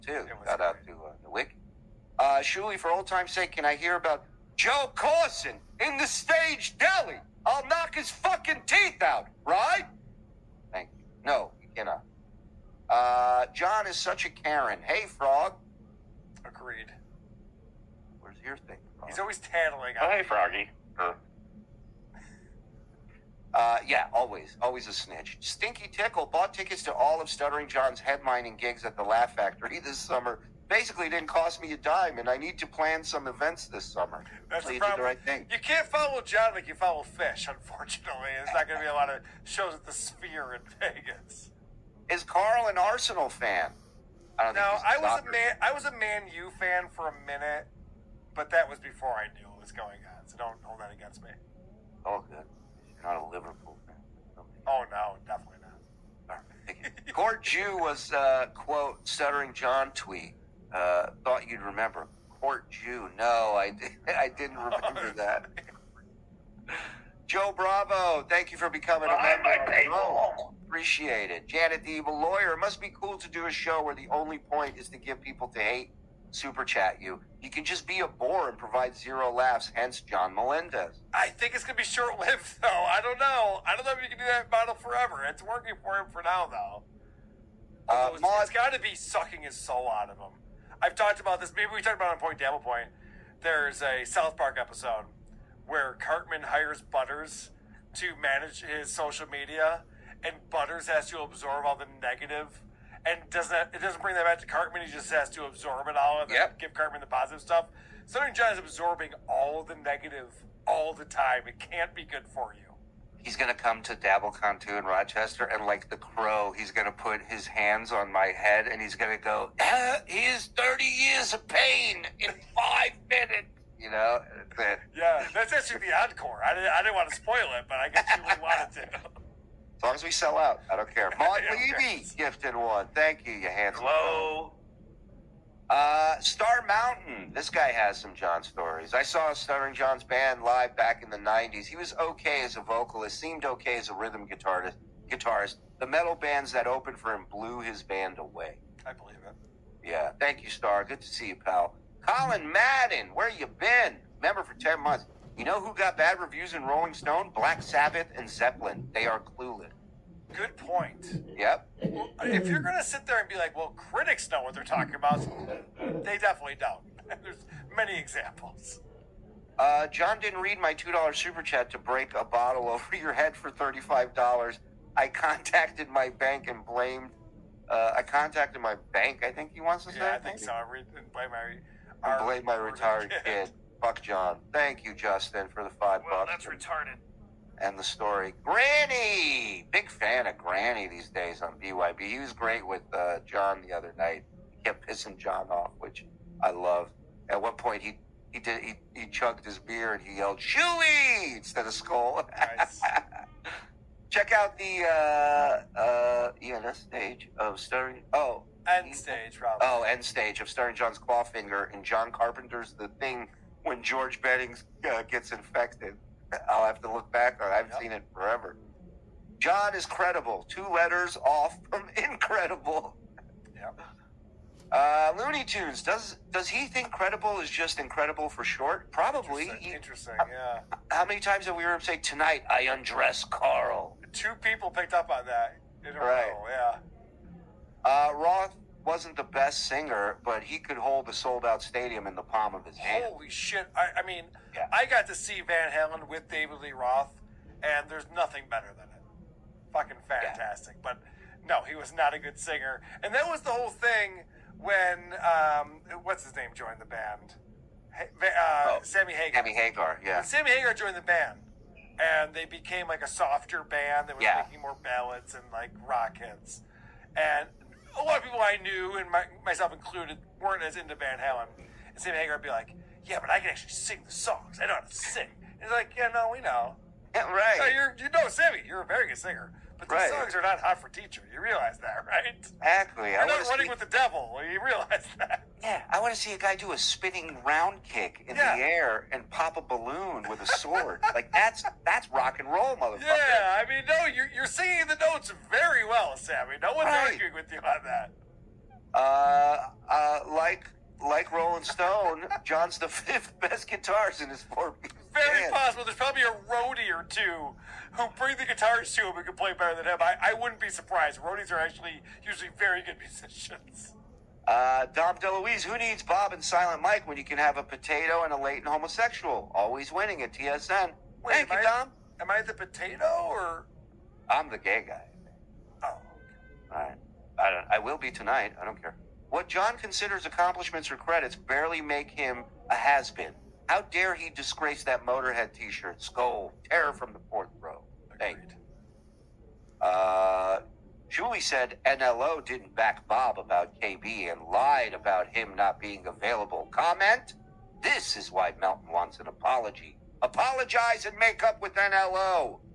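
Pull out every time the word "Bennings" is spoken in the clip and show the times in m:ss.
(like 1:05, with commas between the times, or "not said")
3:34.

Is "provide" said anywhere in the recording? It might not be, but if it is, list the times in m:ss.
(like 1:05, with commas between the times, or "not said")
1:18.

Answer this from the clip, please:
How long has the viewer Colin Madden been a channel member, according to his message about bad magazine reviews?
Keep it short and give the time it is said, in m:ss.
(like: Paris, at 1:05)
10 months, at 2:34.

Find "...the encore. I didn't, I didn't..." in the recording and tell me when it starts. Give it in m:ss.
2:05.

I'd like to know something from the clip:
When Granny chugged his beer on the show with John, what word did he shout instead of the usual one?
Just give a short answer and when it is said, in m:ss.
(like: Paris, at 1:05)
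Chewy, at 3:20.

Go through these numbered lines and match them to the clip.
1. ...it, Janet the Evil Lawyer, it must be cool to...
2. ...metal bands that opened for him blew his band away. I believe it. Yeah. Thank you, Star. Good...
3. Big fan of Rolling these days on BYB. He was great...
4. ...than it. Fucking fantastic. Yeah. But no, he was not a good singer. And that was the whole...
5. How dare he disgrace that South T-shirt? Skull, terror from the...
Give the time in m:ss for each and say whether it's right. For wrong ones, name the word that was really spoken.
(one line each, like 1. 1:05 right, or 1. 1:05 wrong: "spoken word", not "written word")
1. 1:11 right
2. 2:25 right
3. 3:09 wrong: "Granny", not "Rolling"
4. 4:08 right
5. 5:33 wrong: "Motorhead", not "South".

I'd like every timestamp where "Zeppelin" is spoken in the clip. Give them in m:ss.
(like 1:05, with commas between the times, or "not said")
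2:38.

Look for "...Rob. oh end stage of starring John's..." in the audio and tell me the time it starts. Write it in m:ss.
3:29.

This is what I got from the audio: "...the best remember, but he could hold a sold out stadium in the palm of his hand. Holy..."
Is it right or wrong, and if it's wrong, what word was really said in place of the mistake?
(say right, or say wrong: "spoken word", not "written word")
wrong: "singer", not "remember".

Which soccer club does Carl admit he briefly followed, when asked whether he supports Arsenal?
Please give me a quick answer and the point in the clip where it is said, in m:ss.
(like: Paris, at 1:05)
Man U, at 0:45.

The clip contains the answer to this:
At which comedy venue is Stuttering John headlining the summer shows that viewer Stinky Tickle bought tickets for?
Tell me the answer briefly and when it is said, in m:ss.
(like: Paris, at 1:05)
Laugh Factory, at 0:29.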